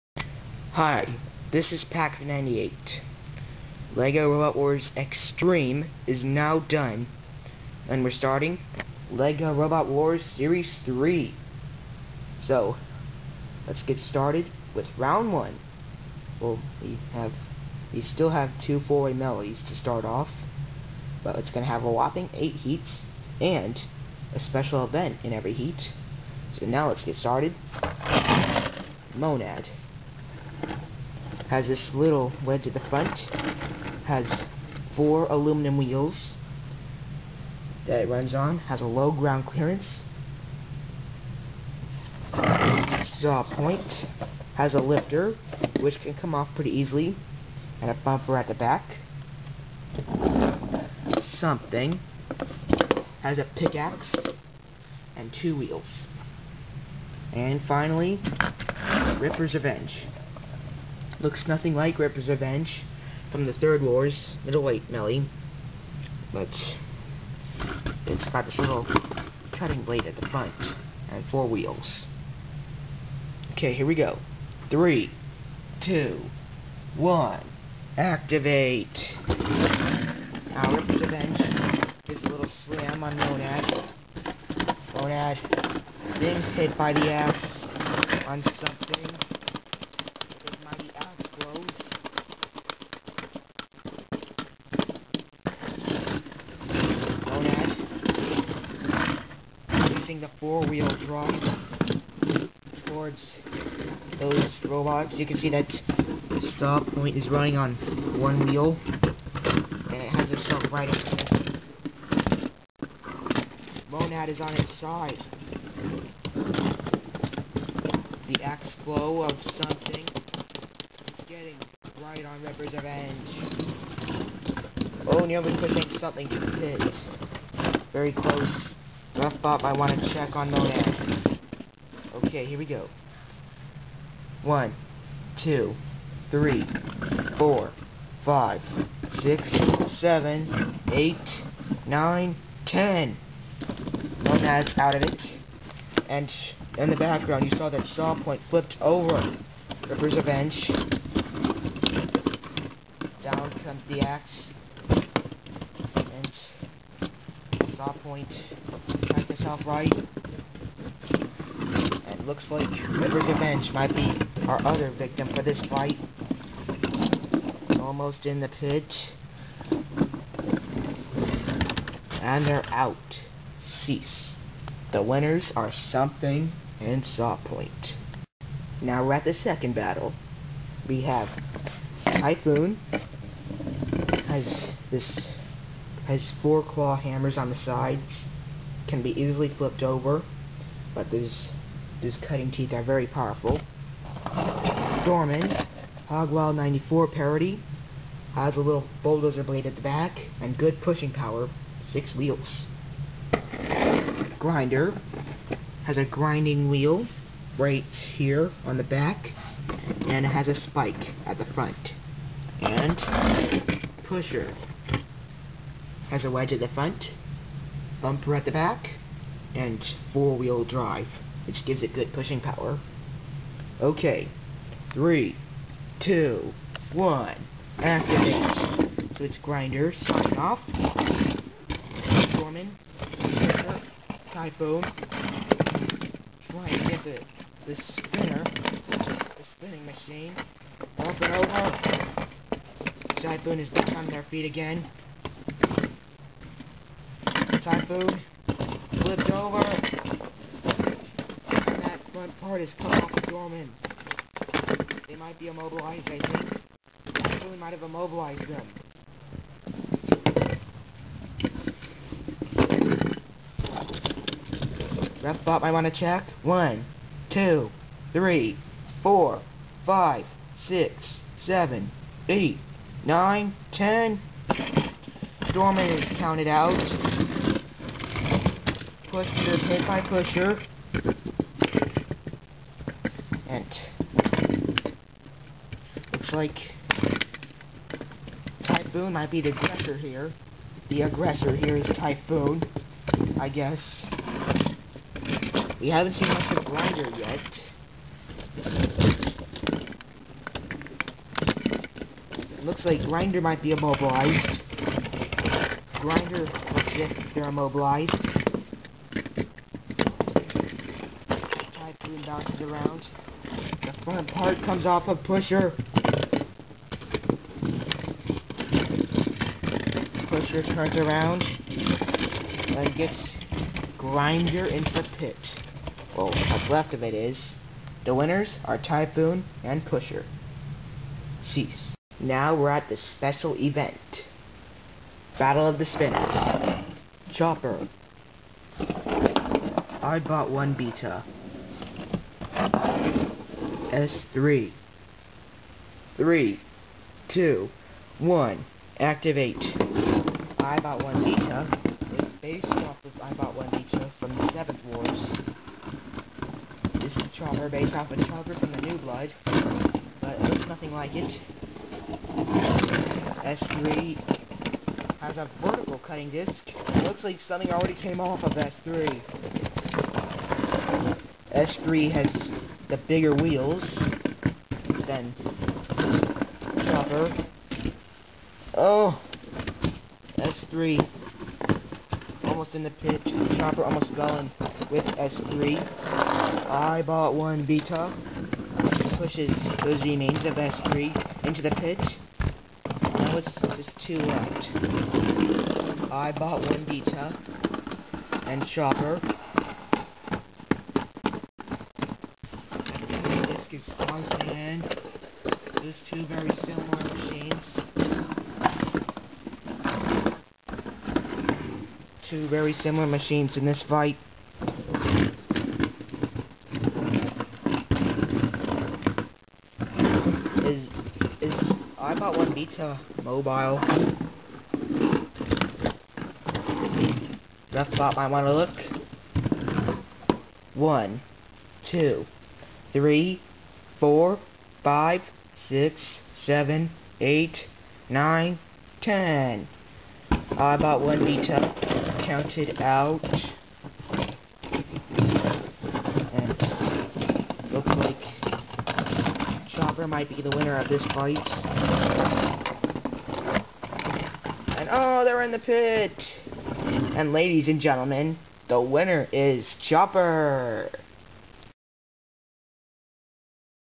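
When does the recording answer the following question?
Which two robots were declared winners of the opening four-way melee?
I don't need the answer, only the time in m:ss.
2:55.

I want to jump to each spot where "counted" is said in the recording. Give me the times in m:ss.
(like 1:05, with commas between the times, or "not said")
4:36, 7:22.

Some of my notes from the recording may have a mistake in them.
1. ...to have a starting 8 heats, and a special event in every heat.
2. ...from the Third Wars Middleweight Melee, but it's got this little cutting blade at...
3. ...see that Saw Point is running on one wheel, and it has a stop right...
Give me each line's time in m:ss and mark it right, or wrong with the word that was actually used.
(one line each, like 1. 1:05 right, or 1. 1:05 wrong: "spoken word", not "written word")
1. 0:21 wrong: "whopping", not "starting"
2. 1:03 right
3. 1:45 right.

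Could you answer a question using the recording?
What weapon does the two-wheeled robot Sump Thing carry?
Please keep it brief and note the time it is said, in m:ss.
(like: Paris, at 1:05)
A pickaxe, at 0:53.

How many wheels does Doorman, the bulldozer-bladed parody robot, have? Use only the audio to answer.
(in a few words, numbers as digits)
6.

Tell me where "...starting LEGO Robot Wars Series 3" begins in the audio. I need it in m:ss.
0:08.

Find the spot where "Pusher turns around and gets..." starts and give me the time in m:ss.
5:20.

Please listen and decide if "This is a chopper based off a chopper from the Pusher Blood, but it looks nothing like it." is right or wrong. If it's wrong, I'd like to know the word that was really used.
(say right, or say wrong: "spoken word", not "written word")
wrong: "New", not "Pusher".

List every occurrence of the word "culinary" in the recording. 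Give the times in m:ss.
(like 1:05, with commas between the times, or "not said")
not said.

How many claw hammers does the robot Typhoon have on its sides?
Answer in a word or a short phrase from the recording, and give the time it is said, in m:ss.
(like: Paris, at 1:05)
4, at 3:06.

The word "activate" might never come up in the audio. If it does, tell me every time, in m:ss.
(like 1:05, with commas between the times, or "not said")
1:17, 3:47, 5:49.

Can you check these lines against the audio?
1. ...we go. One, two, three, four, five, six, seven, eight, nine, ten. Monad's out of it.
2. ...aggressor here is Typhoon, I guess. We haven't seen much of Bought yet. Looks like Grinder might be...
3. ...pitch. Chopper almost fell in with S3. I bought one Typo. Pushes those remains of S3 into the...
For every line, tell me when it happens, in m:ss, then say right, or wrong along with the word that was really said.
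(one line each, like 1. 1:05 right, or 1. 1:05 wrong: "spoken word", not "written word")
1. 2:12 right
2. 4:51 wrong: "Grinder", not "Bought"
3. 6:22 wrong: "Beta", not "Typo".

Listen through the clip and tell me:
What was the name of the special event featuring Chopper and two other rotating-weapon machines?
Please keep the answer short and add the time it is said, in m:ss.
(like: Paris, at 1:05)
Battle of the Spinners, at 5:35.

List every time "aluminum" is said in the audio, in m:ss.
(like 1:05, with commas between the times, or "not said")
0:35.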